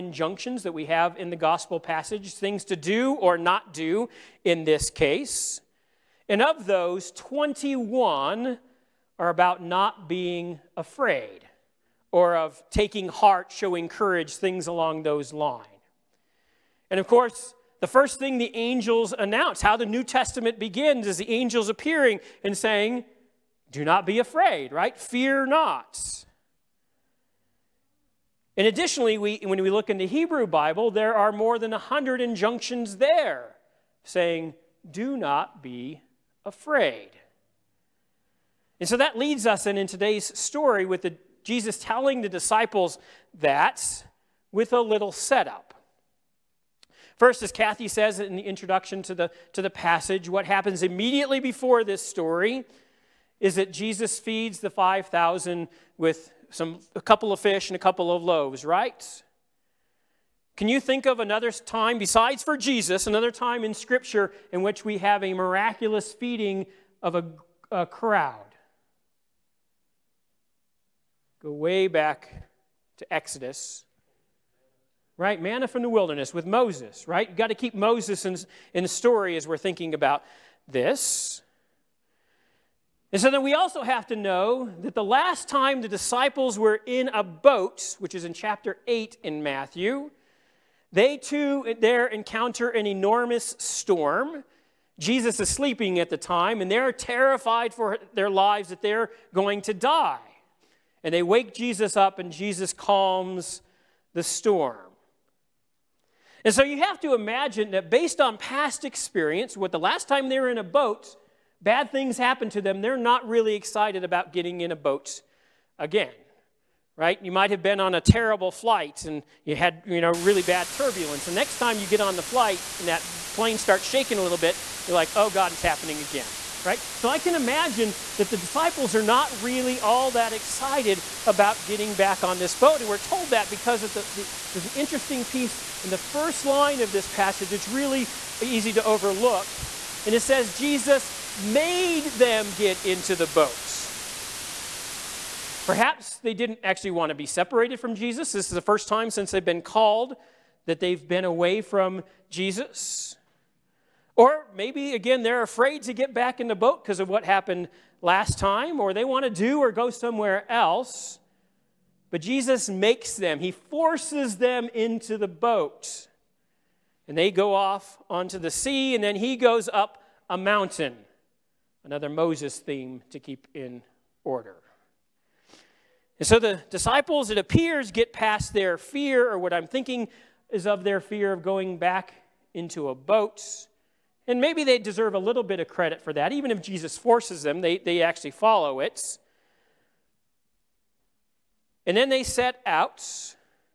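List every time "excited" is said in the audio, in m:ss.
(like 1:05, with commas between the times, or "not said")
1:53, 2:10.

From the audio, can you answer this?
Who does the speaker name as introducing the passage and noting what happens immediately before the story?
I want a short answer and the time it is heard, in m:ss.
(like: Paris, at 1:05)
Kathy, at 0:47.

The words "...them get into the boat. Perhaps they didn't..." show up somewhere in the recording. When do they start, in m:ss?
2:22.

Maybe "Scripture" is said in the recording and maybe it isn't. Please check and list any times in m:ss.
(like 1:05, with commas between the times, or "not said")
1:03.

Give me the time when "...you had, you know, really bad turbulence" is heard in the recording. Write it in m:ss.
1:59.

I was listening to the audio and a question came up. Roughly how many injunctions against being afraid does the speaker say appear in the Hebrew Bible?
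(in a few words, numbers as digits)
more than 100.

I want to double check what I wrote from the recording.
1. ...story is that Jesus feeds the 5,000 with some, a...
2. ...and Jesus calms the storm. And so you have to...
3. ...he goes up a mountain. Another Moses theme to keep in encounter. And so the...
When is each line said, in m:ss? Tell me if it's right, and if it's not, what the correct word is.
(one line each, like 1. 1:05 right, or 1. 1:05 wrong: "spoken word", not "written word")
1. 0:52 right
2. 1:42 right
3. 2:49 wrong: "order", not "encounter".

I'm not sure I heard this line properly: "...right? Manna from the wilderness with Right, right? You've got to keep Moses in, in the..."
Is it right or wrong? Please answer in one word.
wrong.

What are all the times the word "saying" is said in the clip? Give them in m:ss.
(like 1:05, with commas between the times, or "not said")
0:22, 0:34.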